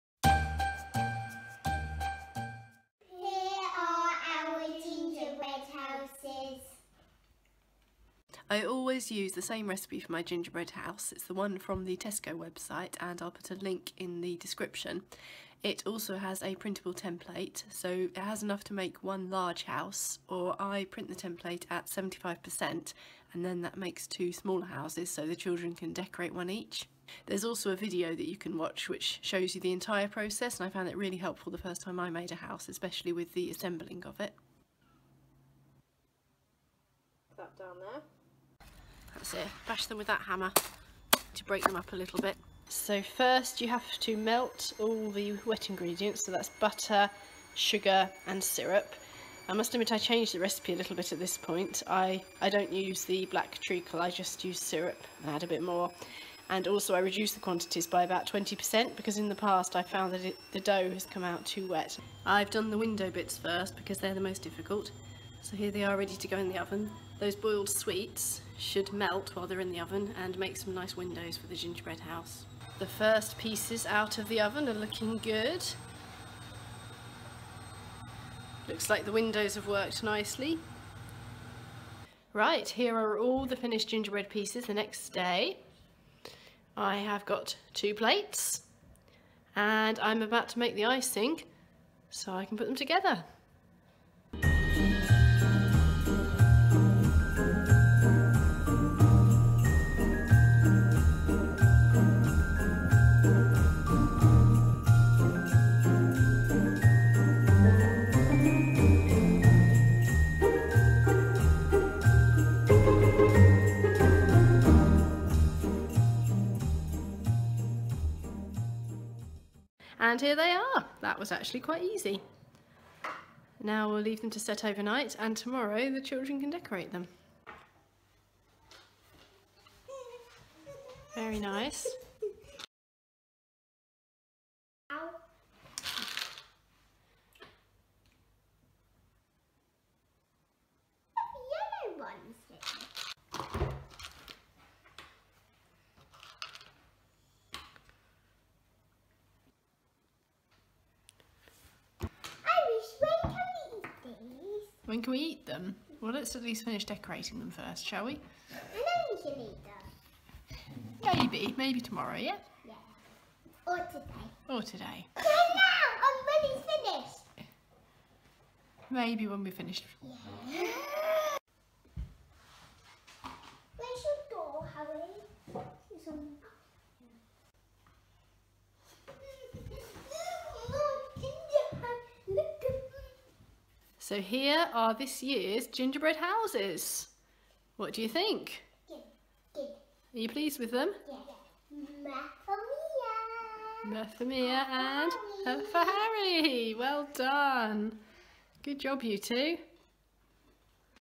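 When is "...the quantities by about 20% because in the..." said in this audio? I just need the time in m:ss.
0:57.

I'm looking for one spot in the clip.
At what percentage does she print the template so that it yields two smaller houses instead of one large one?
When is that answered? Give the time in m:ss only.
0:21.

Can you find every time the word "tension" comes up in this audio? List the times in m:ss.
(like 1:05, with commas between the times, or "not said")
not said.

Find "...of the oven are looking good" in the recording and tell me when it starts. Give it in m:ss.
1:14.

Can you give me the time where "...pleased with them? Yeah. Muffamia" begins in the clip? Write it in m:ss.
3:10.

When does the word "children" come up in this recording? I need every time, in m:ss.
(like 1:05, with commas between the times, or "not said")
0:25, 2:06.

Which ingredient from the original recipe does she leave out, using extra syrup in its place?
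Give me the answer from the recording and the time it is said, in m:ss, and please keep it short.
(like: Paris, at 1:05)
black treacle, at 0:53.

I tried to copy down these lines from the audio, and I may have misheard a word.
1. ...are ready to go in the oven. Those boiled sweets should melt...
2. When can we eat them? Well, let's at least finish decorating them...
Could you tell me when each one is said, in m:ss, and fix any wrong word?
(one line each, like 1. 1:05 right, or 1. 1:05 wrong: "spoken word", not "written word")
1. 1:05 right
2. 2:34 right.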